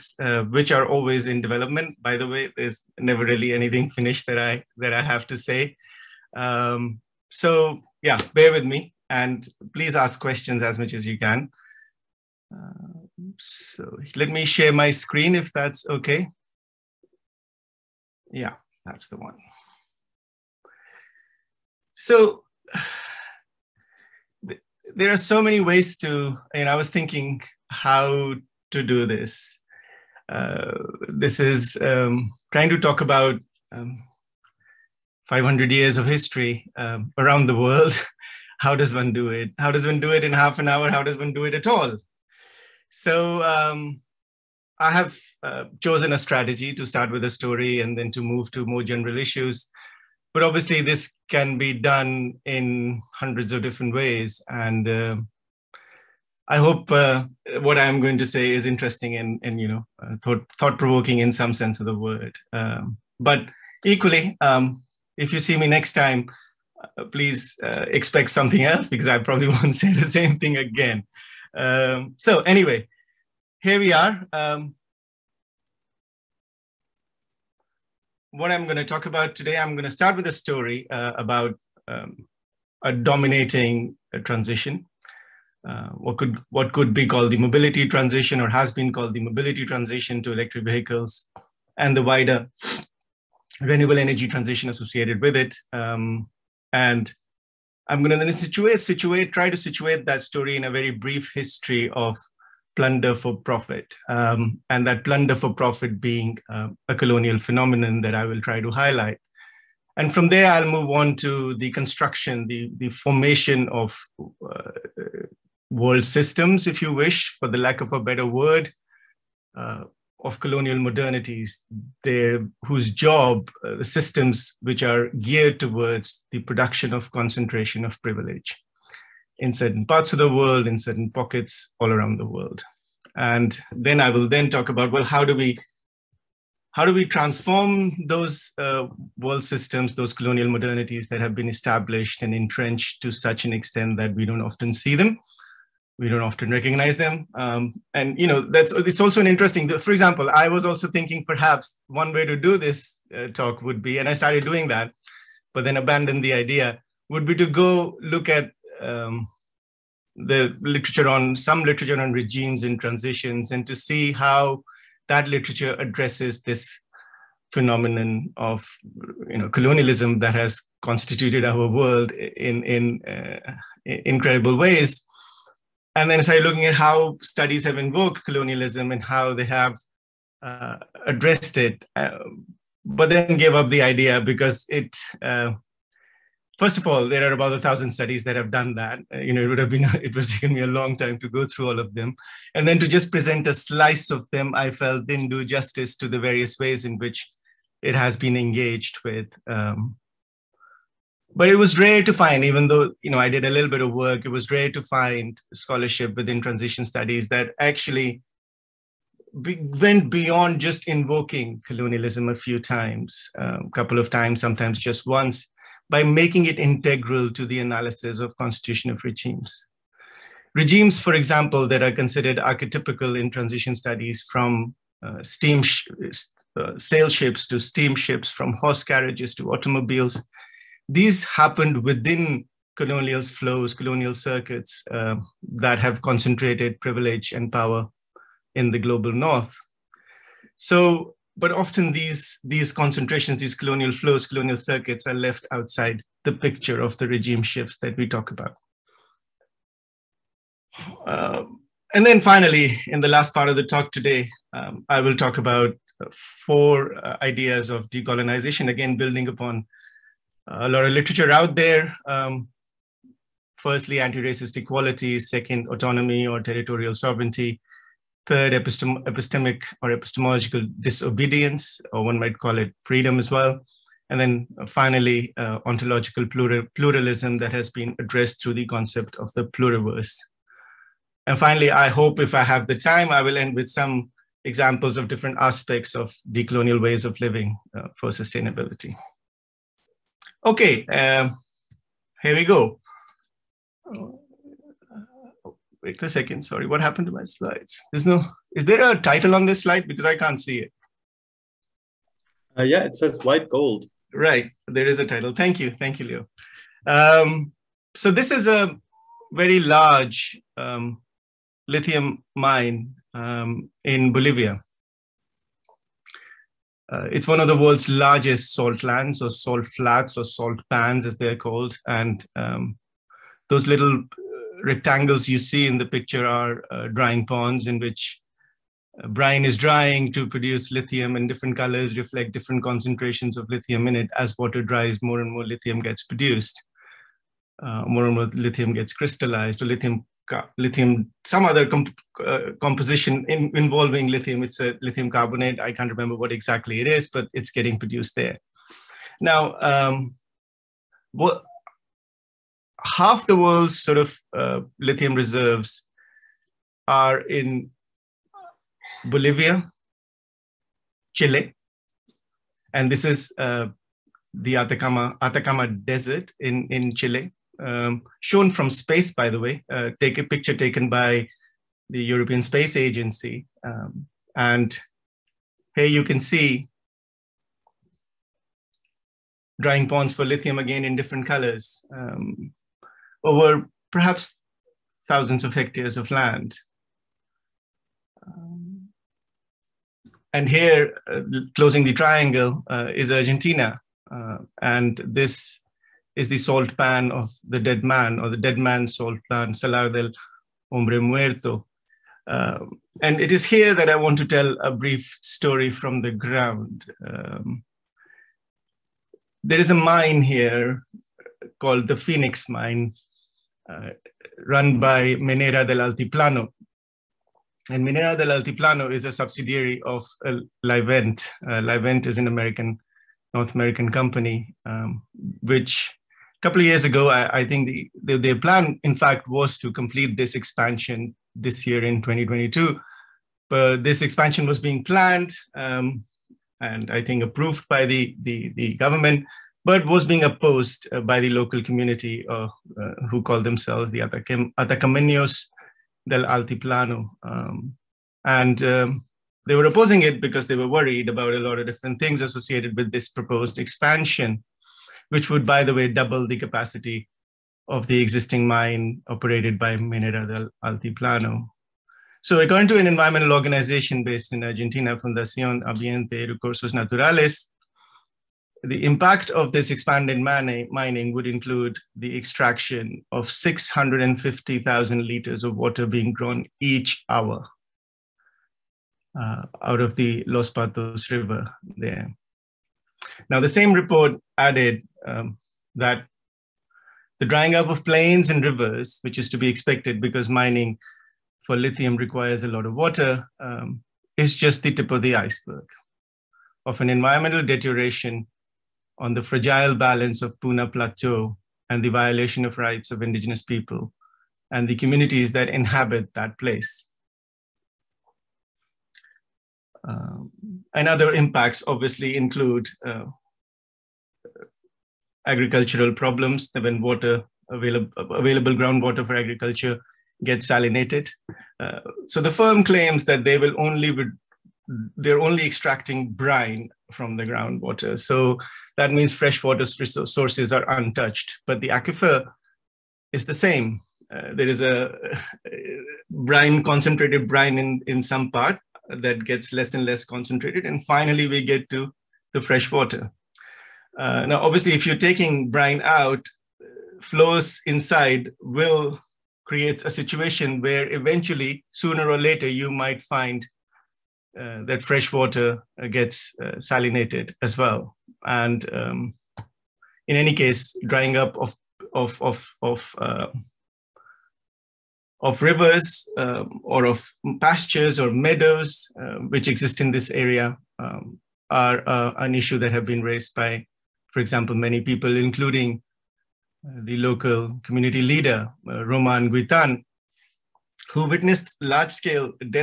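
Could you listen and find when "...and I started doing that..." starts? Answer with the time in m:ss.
2:33.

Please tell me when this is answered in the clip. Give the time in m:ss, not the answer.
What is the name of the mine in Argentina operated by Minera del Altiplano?
6:51.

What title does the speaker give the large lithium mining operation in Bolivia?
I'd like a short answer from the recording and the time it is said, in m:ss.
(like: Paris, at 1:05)
White gold, at 5:03.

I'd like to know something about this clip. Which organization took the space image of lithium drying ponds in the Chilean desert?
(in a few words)
European Space Agency.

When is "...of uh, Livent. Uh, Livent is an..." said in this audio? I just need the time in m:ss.
6:59.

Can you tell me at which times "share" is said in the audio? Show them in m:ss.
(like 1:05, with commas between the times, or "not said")
0:14.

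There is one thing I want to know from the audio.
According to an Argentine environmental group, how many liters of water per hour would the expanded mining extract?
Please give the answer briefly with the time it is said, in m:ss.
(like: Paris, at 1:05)
650,000, at 7:53.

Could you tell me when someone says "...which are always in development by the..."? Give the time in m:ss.
0:00.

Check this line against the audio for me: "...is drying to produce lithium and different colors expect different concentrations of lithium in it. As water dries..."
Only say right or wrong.
wrong.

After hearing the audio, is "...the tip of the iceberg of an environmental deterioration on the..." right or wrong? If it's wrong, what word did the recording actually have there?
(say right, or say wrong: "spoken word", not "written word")
right.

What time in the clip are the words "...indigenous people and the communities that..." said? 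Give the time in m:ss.
8:23.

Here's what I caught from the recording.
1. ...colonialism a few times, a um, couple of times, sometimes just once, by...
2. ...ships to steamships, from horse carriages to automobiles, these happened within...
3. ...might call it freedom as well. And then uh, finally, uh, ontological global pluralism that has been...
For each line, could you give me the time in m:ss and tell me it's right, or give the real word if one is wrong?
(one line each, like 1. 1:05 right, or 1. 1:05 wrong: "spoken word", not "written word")
1. 3:31 right
2. 3:47 right
3. 4:32 wrong: "plural", not "global".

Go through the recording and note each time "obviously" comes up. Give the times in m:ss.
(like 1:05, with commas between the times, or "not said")
0:50, 8:31, 9:04.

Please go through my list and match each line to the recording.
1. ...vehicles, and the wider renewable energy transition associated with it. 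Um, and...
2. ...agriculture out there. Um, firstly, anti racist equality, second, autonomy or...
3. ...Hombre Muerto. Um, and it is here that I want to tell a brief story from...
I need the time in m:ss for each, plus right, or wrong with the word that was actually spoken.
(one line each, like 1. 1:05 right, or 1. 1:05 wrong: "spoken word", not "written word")
1. 1:30 right
2. 4:20 wrong: "literature", not "agriculture"
3. 6:40 right.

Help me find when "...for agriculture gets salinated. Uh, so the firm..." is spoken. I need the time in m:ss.
8:39.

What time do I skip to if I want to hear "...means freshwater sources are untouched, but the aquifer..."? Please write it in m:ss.
8:48.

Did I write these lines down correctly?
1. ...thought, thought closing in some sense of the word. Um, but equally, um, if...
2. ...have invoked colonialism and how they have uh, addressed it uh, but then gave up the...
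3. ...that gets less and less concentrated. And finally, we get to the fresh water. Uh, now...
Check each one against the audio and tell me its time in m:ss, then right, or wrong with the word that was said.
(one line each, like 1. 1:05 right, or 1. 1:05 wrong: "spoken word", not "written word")
1. 1:00 wrong: "provoking", not "closing"
2. 2:57 right
3. 8:58 right.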